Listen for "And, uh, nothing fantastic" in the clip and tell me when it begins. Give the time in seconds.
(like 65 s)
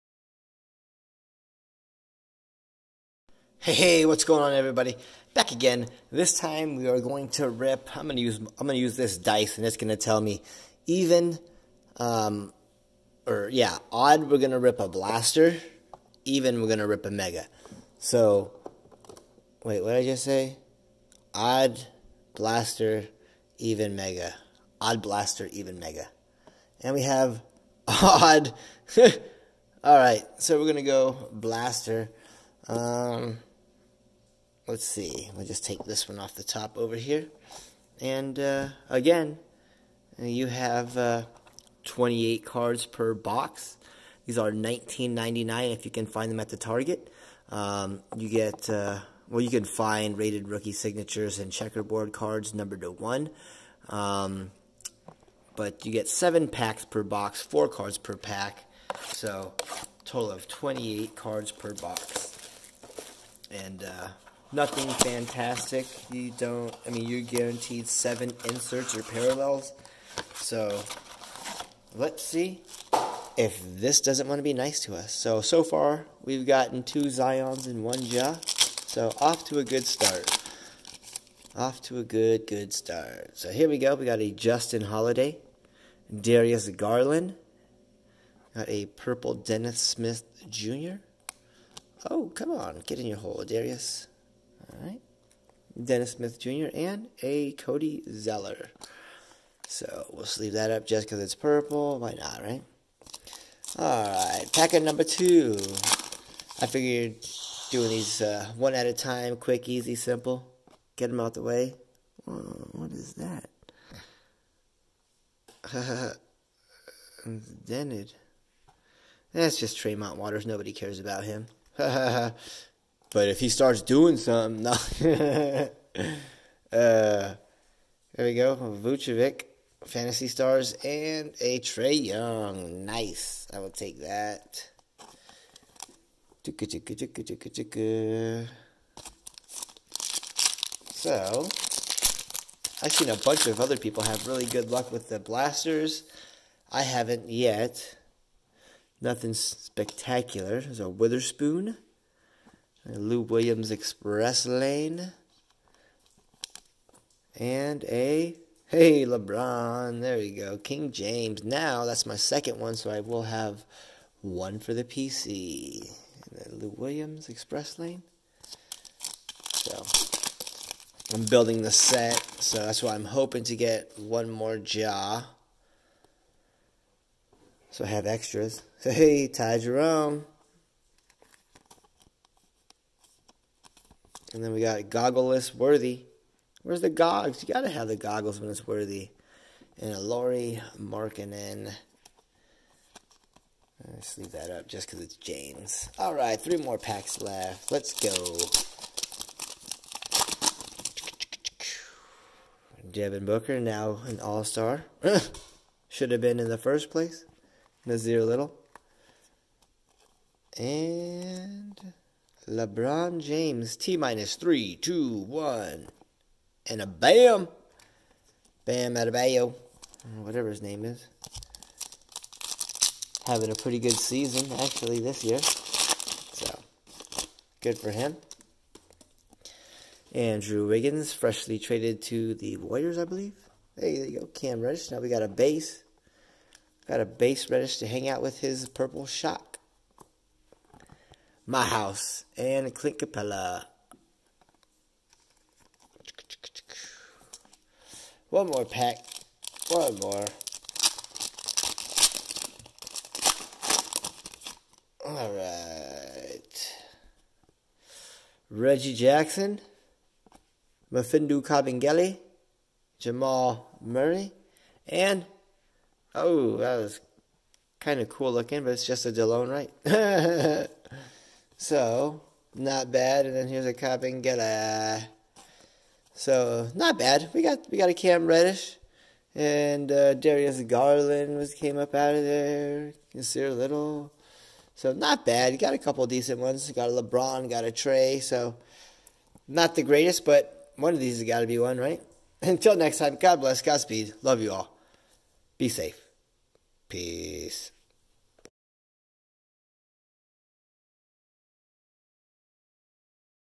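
63 s.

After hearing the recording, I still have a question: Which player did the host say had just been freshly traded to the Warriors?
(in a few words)
Andrew Wiggins.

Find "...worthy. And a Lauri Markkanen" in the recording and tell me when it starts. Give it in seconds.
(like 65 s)
188 s.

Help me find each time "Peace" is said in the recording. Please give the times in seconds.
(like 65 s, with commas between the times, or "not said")
296 s.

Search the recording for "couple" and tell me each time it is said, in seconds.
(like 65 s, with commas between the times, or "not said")
285 s.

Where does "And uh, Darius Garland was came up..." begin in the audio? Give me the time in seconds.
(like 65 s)
279 s.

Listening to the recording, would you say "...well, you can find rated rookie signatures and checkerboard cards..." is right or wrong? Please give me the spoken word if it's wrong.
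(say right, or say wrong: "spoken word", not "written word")
right.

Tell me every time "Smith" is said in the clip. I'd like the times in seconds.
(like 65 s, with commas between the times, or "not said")
89 s, 96 s.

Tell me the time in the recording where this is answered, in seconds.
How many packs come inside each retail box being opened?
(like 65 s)
56 s.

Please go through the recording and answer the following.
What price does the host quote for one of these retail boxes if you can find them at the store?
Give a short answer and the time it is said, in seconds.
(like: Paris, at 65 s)
$19.99, at 44 s.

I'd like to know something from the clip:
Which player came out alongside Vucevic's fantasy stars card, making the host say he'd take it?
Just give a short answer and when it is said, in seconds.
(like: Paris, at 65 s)
Trae Young, at 131 s.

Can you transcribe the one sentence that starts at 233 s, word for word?
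Hey, there you go, Cam Reddish.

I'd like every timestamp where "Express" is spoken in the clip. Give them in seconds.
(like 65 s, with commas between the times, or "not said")
153 s, 167 s.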